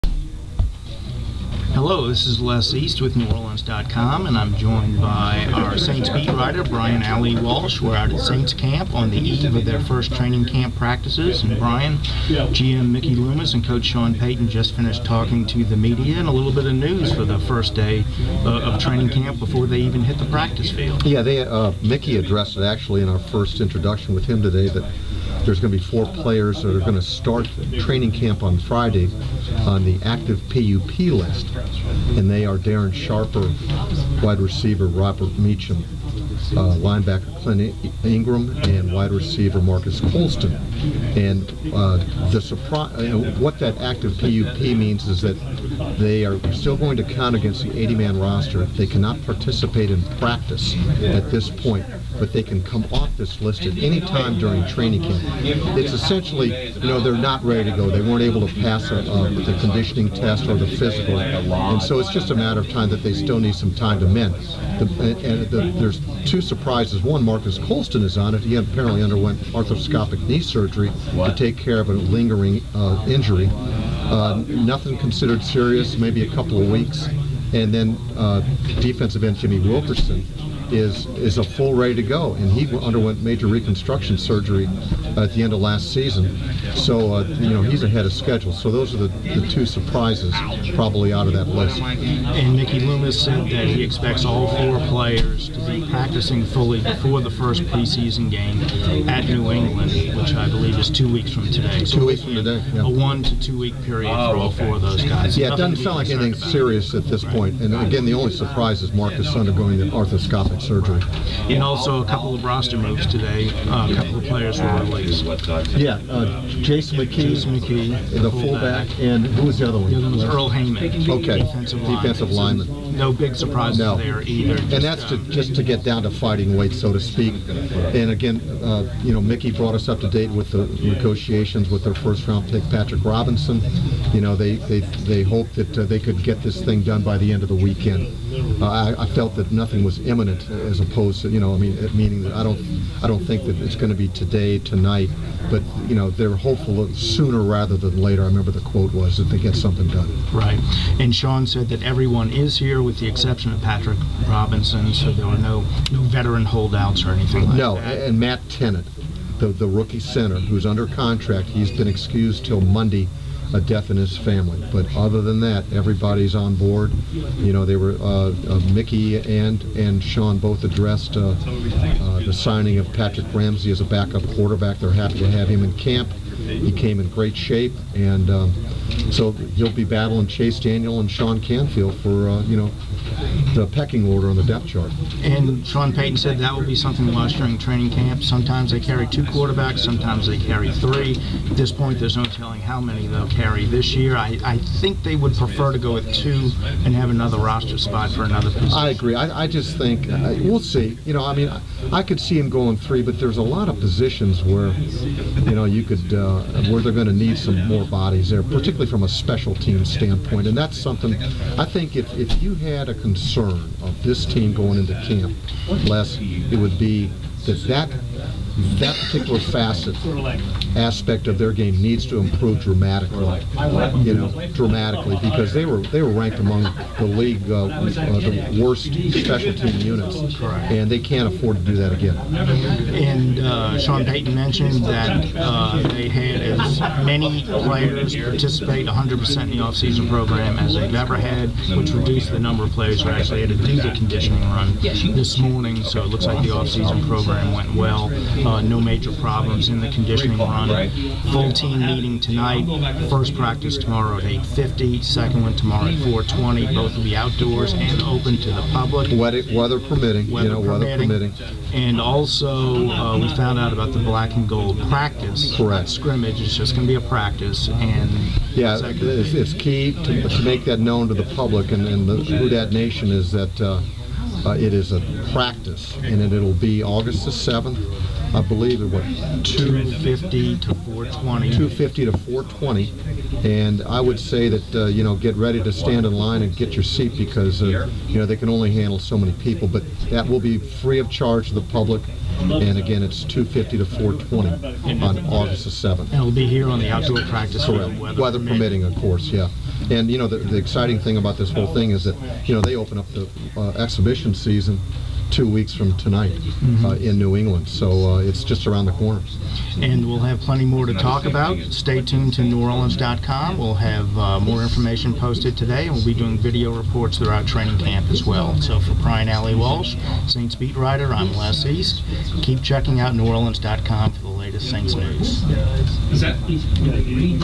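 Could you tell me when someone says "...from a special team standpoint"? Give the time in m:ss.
3:28.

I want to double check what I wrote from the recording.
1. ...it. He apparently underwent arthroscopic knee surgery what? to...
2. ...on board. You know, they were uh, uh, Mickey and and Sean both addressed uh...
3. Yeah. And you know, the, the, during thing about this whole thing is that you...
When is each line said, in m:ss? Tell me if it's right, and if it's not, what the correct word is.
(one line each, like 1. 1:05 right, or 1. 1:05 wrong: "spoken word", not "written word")
1. 1:08 right
2. 2:46 right
3. 4:59 wrong: "exciting", not "during".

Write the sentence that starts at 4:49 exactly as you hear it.
But that will be free of charge to the public, and again it's 250 to 420 on August the 7th.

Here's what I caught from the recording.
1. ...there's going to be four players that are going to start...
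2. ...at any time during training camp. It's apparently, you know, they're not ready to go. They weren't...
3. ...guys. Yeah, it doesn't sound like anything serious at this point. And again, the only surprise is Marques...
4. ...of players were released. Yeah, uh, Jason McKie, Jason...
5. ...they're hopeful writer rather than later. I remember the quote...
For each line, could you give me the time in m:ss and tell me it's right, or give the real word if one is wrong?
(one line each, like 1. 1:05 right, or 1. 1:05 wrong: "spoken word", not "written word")
1. 0:25 right
2. 0:53 wrong: "essentially", not "apparently"
3. 1:45 right
4. 1:54 right
5. 2:26 wrong: "sooner", not "writer".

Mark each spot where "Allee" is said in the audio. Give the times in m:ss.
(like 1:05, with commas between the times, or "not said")
0:07, 5:19.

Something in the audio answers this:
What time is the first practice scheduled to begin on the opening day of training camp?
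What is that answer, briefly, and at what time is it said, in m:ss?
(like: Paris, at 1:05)
8:50, at 4:14.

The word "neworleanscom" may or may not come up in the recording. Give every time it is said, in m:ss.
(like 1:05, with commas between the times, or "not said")
0:03, 5:12, 5:23.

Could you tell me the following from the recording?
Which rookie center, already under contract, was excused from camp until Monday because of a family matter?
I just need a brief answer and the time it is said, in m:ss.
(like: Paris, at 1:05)
Matt Tennant, at 2:38.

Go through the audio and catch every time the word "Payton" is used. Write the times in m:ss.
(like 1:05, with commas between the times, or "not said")
0:14, 3:05, 3:54.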